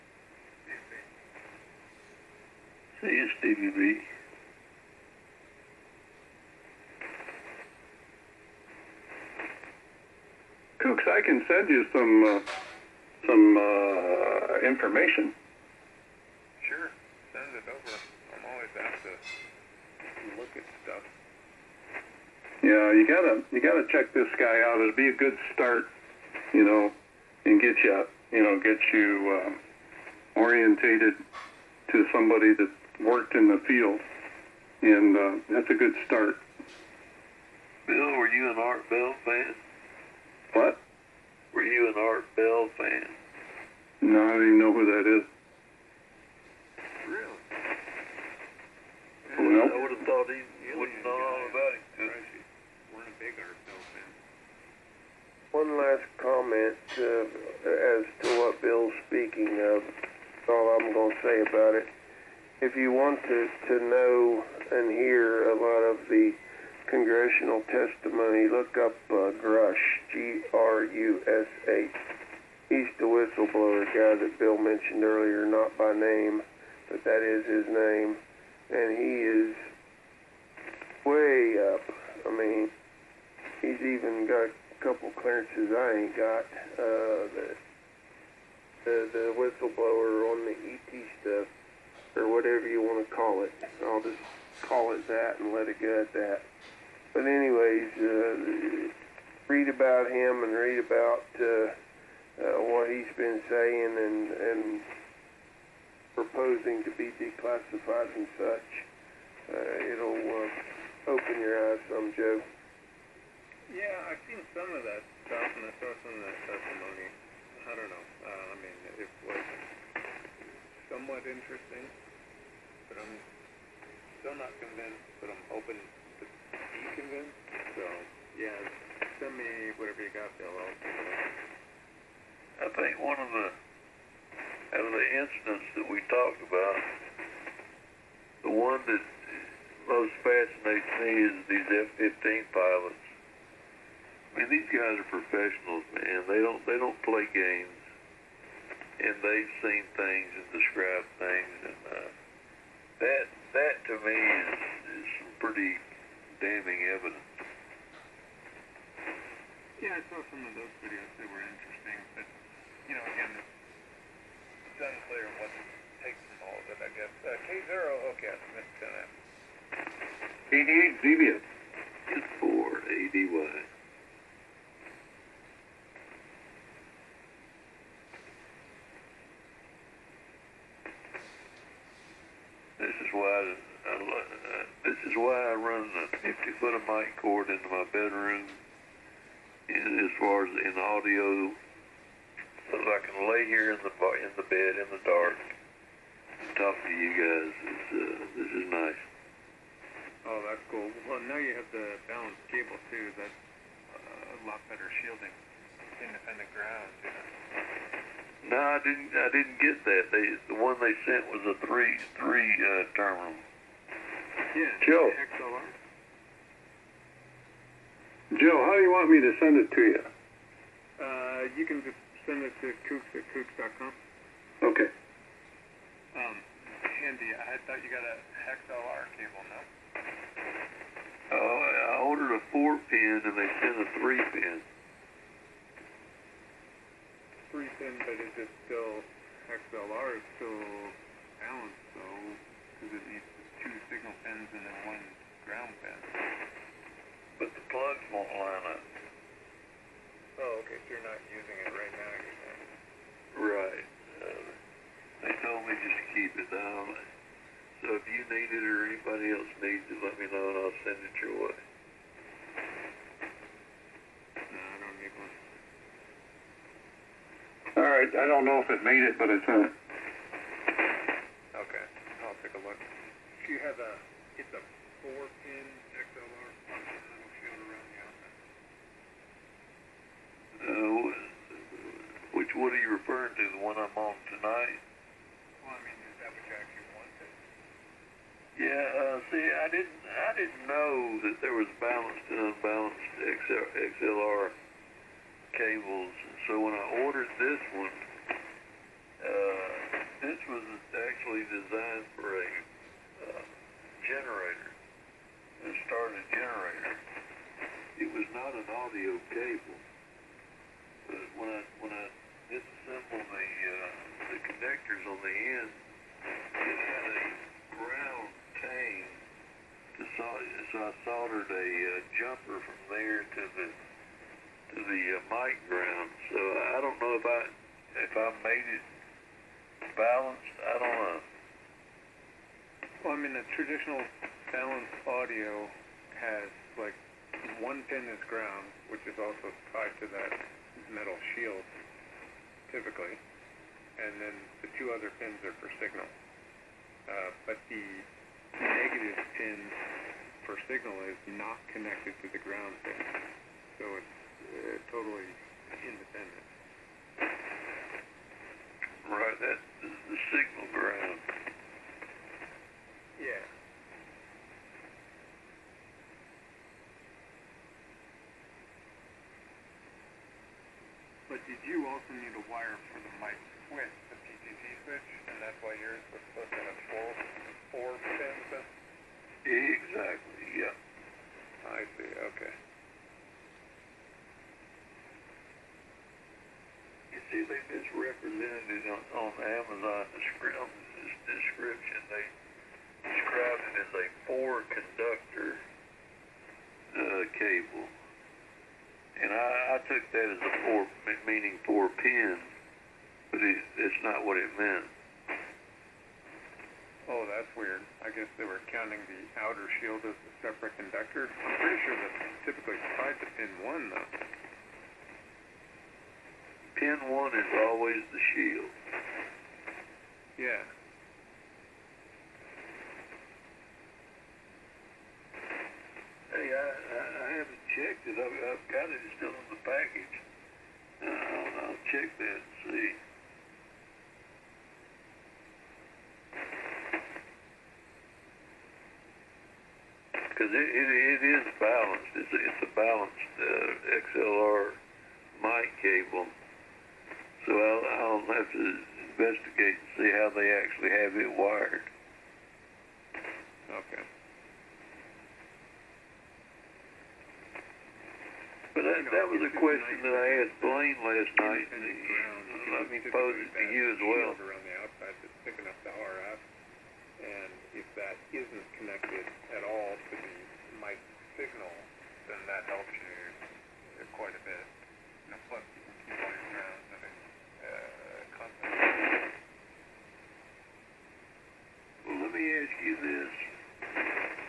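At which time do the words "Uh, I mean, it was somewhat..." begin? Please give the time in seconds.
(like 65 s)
118 s.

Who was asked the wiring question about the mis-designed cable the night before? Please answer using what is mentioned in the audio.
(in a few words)
Blaine.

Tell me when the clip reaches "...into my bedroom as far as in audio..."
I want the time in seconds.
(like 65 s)
187 s.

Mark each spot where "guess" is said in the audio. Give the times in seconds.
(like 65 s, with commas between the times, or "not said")
166 s, 408 s.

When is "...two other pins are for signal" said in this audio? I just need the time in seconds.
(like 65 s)
344 s.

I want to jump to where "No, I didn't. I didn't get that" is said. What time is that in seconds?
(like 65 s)
208 s.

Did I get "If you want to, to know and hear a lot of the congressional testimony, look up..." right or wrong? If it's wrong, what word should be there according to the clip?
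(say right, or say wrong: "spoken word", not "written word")
right.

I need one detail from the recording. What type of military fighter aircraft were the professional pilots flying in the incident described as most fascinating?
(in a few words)
F-15.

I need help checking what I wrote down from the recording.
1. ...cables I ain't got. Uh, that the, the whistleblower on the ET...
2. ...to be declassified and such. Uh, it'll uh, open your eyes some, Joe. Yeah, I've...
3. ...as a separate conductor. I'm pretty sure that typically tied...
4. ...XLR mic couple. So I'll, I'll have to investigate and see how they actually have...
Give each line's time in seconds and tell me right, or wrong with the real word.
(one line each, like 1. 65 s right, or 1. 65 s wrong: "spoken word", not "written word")
1. 85 s wrong: "clearances", not "cables"
2. 106 s right
3. 410 s right
4. 444 s wrong: "cable", not "couple".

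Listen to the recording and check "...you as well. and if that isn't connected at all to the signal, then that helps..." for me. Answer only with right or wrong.
right.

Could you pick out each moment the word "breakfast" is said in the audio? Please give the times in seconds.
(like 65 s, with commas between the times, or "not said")
not said.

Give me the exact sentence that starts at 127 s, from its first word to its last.
So, yeah, send me whatever you got, Bill.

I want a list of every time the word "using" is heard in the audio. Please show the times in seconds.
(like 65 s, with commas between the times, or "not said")
251 s.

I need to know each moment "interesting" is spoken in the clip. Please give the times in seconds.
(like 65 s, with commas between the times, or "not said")
121 s, 161 s.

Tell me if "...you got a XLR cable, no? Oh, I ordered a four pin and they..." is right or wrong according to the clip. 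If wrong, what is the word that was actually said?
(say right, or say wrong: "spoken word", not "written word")
right.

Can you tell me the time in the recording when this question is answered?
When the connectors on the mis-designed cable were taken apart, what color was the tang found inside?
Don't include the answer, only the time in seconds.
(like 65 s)
317 s.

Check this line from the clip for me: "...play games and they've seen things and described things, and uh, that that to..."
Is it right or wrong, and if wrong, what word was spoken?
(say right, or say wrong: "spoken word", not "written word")
right.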